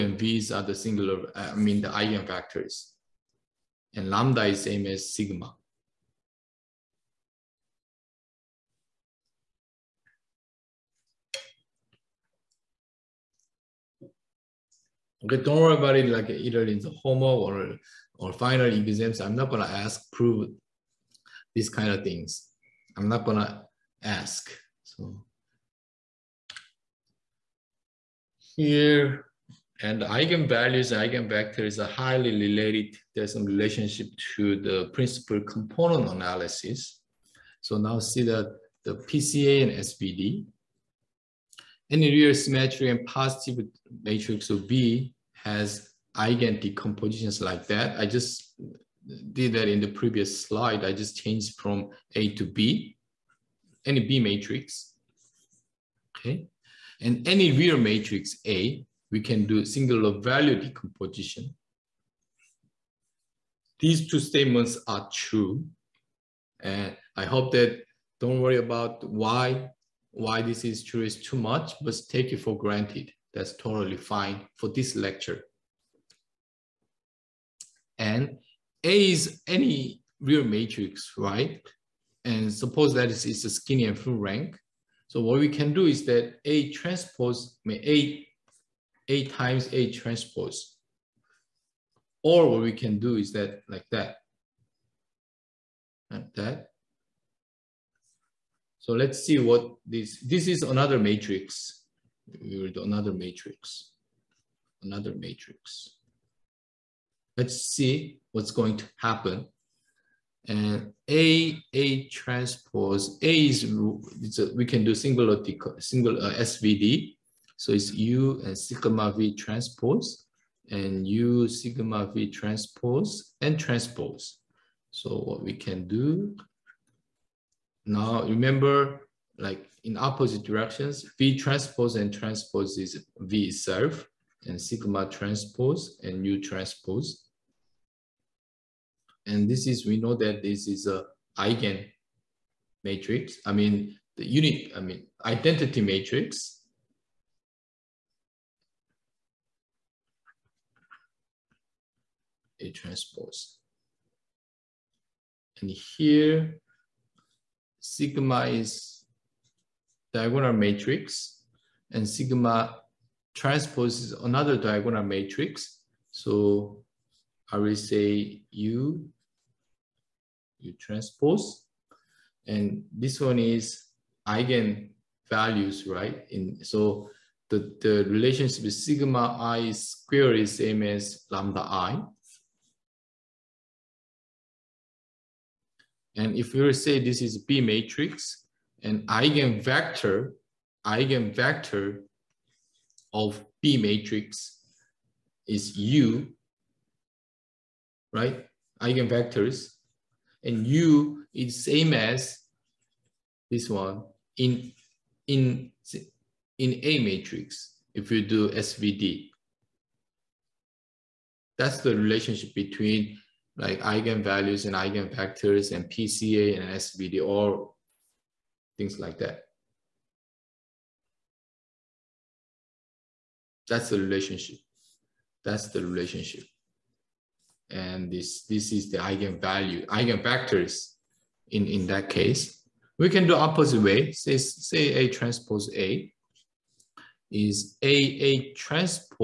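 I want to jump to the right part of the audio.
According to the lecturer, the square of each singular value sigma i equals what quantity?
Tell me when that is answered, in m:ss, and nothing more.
3:01.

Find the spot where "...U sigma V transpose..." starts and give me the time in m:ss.
2:01.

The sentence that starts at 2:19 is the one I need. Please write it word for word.
And this is, we know that this is a eigen matrix.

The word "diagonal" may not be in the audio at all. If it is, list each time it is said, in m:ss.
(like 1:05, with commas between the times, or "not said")
2:40, 2:44.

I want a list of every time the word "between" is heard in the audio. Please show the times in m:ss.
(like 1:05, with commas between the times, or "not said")
3:32.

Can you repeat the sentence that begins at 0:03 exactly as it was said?
And lambda is same as sigma.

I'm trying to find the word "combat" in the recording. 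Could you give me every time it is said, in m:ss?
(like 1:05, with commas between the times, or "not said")
not said.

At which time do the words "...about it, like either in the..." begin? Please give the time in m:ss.
0:15.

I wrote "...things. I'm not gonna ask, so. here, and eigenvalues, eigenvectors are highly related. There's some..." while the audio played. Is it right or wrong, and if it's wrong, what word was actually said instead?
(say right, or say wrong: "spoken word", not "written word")
right.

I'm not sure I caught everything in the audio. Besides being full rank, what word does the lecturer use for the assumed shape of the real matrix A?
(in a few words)
Skinny.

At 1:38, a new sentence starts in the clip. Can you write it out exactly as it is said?
So let's see what this, this is another matrix.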